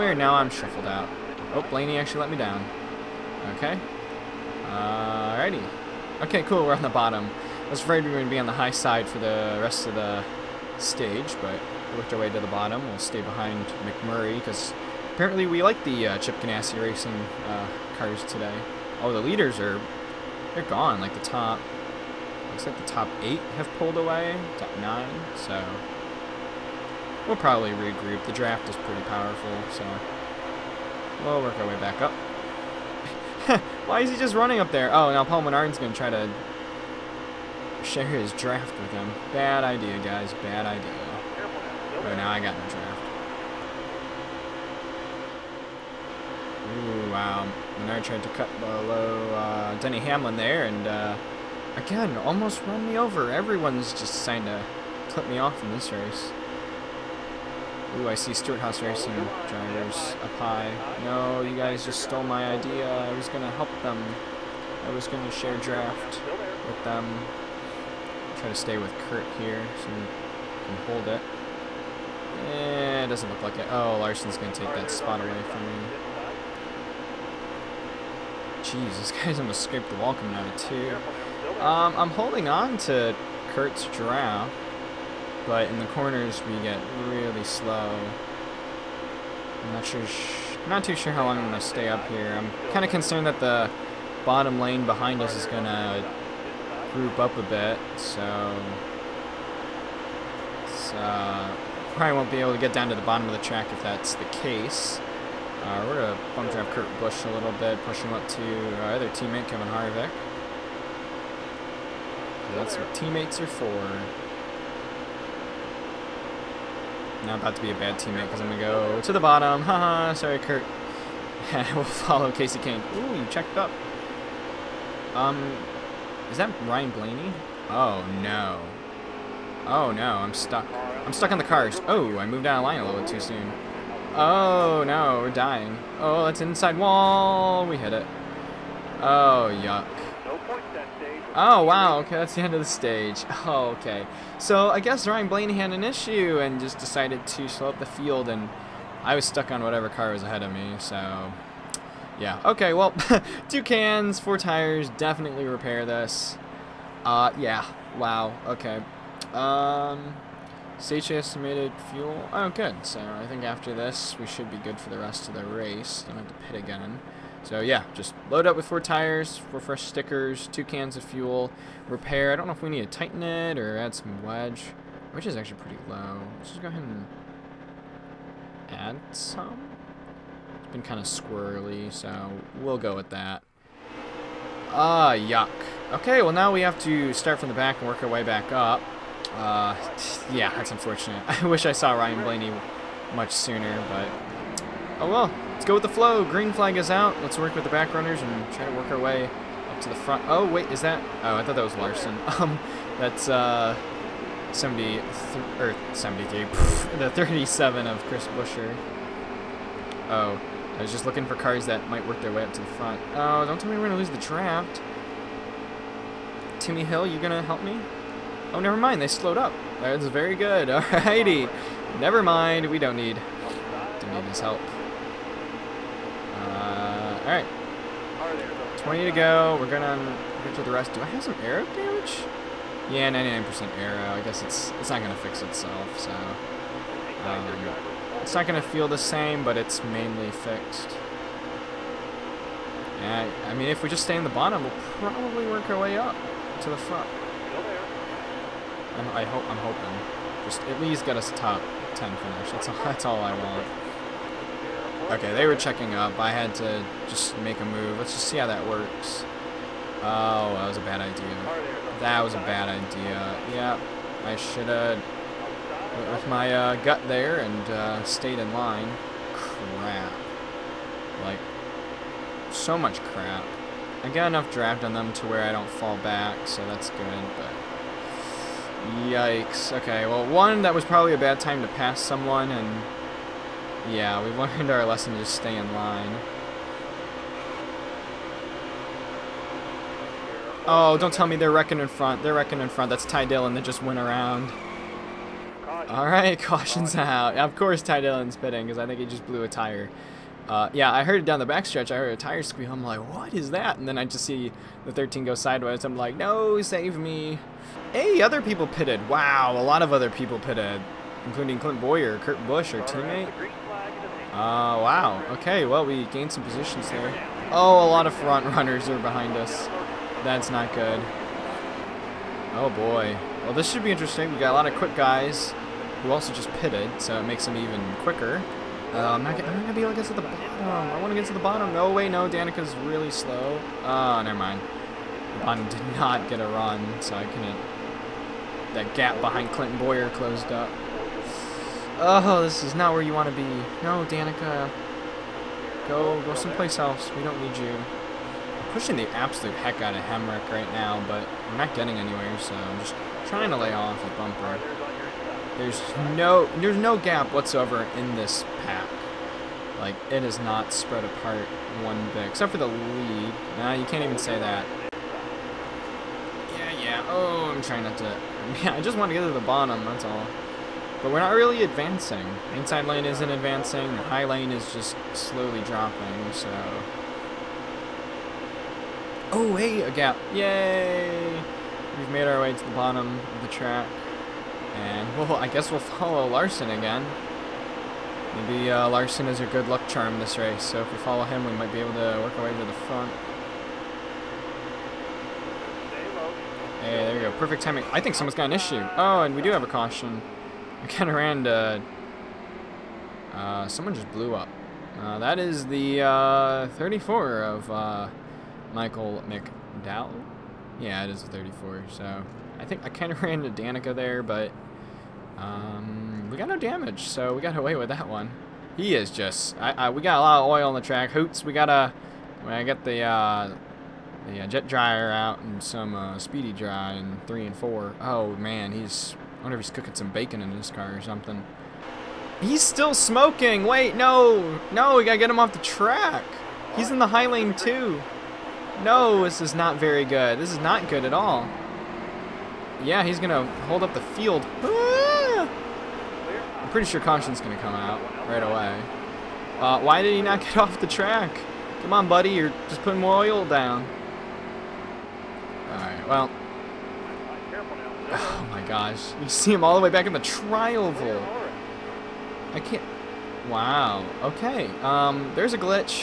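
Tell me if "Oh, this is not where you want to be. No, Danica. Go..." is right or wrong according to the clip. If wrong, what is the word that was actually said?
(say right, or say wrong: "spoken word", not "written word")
right.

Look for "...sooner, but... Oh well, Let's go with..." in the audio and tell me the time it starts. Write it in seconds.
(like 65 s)
193 s.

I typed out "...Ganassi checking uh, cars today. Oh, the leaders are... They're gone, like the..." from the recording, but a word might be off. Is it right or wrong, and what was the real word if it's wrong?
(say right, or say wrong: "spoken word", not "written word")
wrong: "racing", not "checking".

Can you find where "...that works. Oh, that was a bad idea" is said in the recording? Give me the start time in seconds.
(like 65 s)
258 s.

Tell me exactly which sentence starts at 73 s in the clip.
Oh, Larson's going to take that spot away from me.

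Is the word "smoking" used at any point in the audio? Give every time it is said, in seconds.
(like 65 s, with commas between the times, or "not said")
432 s.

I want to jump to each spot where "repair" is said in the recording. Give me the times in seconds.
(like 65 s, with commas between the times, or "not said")
155 s, 171 s.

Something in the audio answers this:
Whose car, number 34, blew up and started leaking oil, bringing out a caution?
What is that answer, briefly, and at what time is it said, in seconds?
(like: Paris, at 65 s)
Michael McDowell, at 408 s.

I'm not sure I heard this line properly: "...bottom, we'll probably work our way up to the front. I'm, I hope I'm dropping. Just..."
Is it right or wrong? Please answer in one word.
wrong.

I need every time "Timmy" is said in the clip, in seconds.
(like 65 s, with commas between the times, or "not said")
216 s.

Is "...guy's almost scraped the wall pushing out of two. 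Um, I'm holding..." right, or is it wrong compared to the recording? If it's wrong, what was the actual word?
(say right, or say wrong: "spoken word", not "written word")
wrong: "coming", not "pushing".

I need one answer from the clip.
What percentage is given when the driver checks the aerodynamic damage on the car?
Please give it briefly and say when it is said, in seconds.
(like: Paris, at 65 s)
99%, at 233 s.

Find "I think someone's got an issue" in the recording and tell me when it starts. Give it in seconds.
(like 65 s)
397 s.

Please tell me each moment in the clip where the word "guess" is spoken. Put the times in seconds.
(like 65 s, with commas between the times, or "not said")
144 s, 234 s, 385 s.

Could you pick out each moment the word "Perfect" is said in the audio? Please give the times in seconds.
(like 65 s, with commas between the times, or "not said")
397 s.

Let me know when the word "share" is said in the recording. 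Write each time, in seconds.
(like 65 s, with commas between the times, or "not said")
37 s, 65 s.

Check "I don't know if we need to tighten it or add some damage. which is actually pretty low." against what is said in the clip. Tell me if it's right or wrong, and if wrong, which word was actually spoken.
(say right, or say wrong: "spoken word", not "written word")
wrong: "wedge", not "damage".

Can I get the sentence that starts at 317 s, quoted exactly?
Oh, a lot of front runners are behind us.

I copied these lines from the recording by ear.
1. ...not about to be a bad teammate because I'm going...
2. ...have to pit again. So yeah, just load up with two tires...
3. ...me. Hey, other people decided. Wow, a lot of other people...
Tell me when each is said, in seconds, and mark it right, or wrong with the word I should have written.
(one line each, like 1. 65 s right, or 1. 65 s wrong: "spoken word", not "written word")
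1. 117 s right
2. 166 s wrong: "four", not "two"
3. 306 s wrong: "pitted", not "decided".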